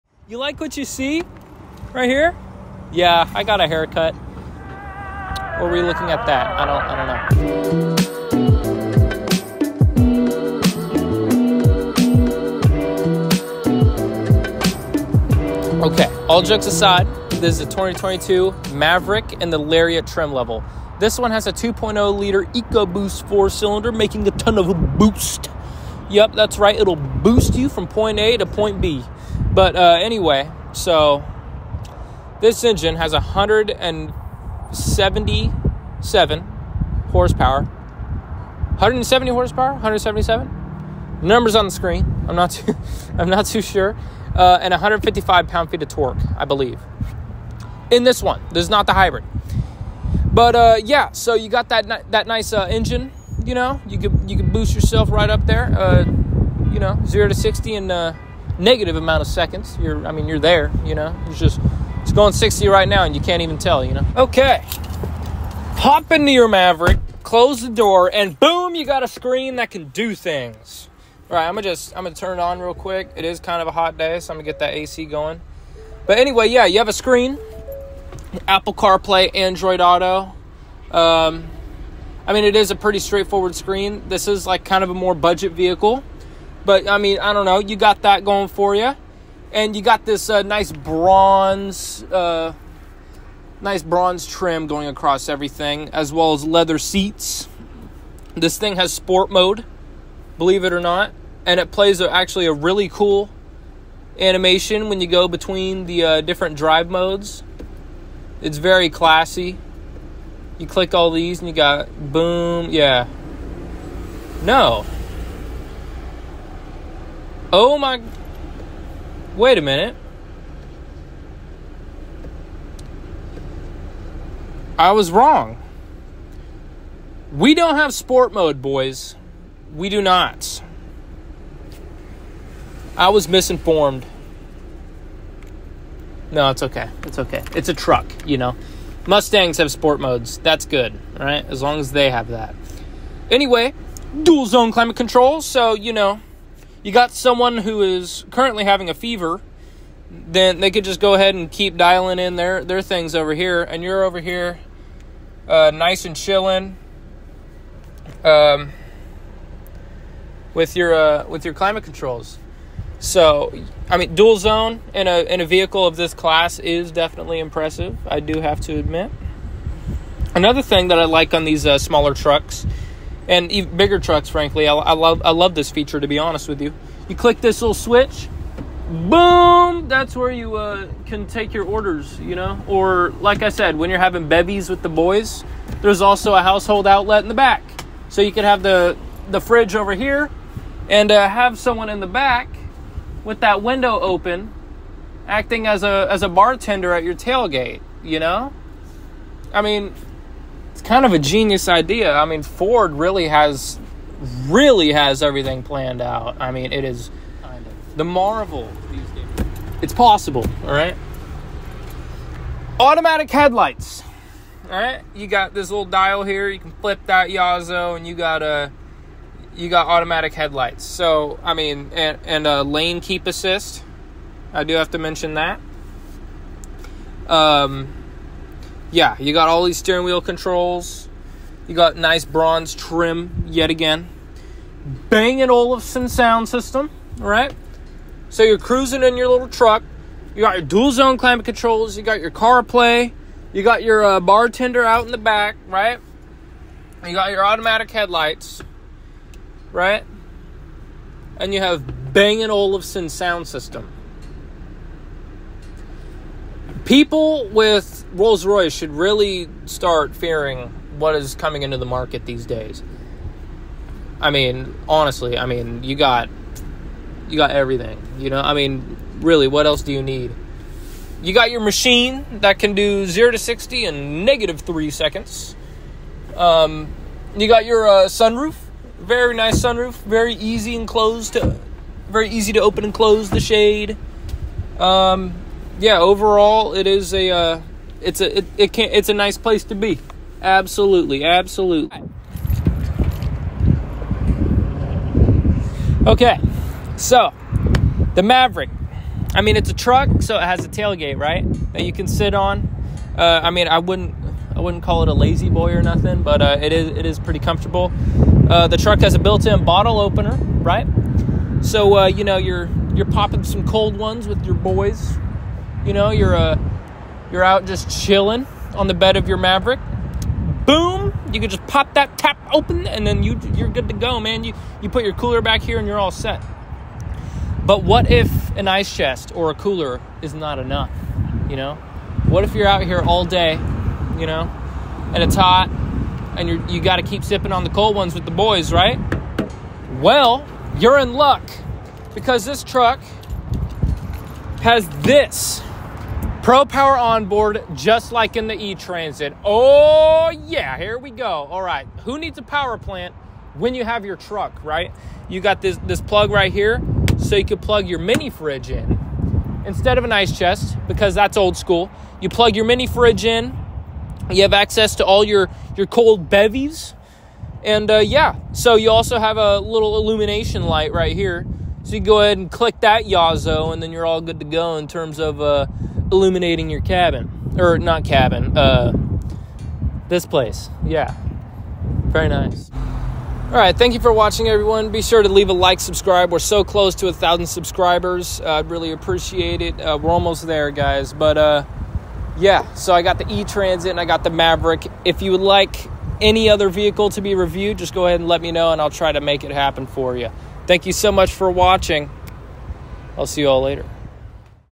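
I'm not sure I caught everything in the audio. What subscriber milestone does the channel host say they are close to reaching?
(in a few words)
1000 subscribers.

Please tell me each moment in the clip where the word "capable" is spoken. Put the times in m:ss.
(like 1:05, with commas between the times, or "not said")
not said.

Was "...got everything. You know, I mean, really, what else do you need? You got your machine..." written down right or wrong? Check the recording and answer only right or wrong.
right.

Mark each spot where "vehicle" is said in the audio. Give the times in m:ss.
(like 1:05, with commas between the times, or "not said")
1:25, 2:45, 6:36.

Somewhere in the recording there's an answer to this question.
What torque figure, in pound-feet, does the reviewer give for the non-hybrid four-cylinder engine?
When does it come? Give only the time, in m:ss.
0:44.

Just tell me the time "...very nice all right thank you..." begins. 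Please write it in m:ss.
6:22.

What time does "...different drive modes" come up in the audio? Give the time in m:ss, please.
1:46.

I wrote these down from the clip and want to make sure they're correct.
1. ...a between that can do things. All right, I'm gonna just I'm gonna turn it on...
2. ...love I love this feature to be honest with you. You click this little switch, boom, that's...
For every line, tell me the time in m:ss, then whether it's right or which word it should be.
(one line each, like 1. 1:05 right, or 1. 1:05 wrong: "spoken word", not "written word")
1. 1:09 wrong: "screen", not "between"
2. 2:54 right.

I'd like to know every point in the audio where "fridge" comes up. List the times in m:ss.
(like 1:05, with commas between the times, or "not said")
3:09, 5:58, 6:02.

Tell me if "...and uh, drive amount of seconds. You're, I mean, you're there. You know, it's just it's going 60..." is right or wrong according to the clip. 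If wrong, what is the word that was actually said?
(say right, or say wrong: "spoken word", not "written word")
wrong: "negative", not "drive".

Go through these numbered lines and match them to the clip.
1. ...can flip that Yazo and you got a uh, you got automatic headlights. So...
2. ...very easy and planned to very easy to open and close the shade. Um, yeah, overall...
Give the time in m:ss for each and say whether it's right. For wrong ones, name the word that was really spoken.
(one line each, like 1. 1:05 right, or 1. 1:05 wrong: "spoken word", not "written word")
1. 3:36 right
2. 4:40 wrong: "closed", not "planned".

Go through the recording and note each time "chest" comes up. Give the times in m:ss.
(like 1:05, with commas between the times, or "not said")
5:28, 6:00.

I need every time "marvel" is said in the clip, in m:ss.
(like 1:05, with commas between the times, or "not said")
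3:28.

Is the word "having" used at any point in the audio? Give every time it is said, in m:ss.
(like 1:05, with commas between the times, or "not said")
2:28, 3:03.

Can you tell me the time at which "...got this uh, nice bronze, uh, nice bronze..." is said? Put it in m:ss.
1:29.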